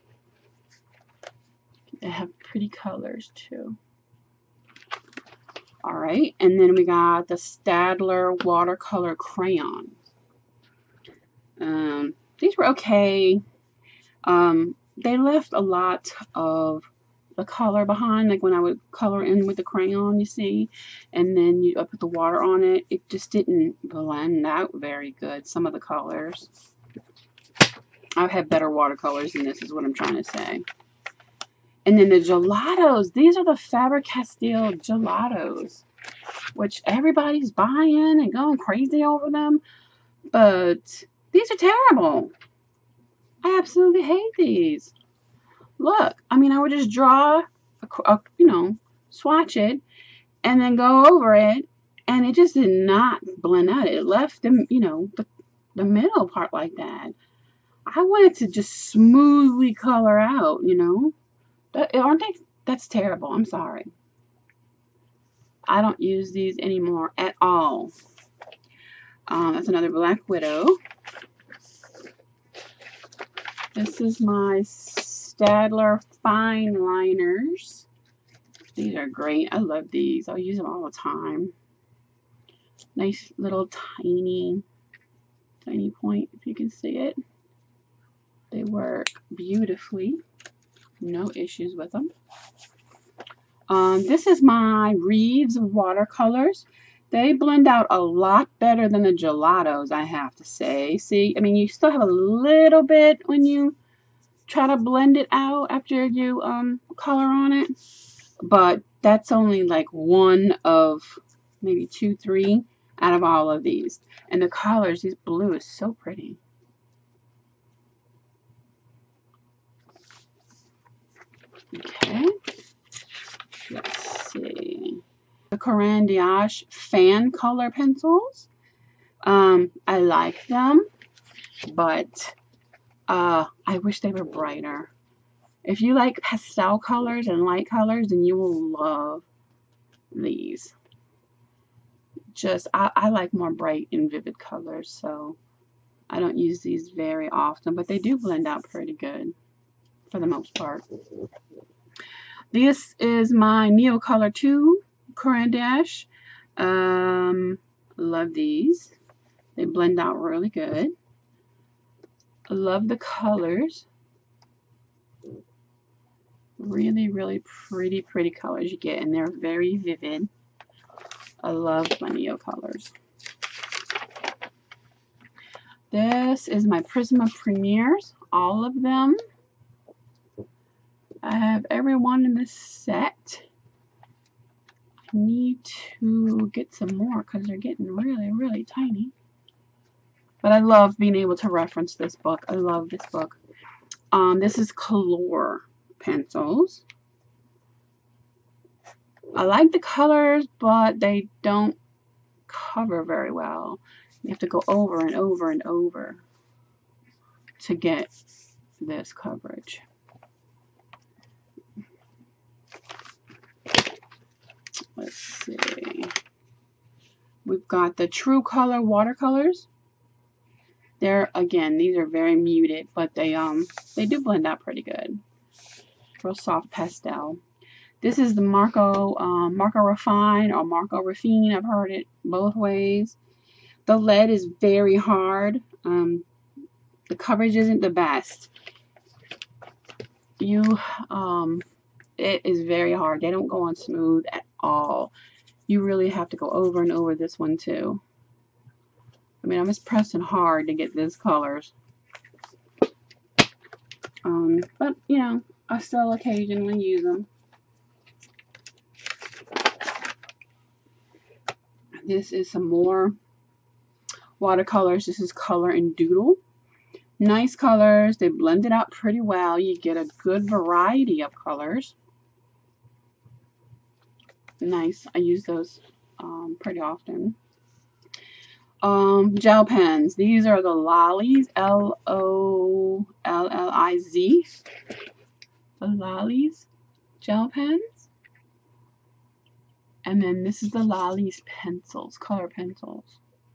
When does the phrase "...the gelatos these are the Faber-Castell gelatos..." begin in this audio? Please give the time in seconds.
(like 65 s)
32 s.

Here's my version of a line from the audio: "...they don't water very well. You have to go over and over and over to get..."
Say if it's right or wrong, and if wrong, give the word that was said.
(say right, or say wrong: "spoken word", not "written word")
wrong: "cover", not "water".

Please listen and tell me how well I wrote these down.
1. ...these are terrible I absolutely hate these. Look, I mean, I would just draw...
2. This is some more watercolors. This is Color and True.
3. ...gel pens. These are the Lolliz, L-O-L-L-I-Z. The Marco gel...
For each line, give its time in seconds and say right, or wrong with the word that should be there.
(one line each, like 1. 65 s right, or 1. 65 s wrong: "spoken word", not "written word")
1. 41 s right
2. 262 s wrong: "Doodle", not "True"
3. 279 s wrong: "Lolliz", not "Marco".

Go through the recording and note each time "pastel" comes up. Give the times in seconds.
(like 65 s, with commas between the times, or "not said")
136 s, 226 s.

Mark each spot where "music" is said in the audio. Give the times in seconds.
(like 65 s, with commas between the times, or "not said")
not said.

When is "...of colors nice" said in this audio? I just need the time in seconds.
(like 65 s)
271 s.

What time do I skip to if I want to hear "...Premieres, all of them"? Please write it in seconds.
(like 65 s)
177 s.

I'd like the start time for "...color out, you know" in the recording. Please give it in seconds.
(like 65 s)
59 s.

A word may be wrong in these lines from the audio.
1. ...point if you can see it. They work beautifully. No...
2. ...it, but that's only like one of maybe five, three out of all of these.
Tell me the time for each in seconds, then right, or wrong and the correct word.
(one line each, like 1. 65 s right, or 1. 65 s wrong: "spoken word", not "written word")
1. 85 s right
2. 107 s wrong: "two", not "five".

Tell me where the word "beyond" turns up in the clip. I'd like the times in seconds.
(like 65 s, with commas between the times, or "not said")
not said.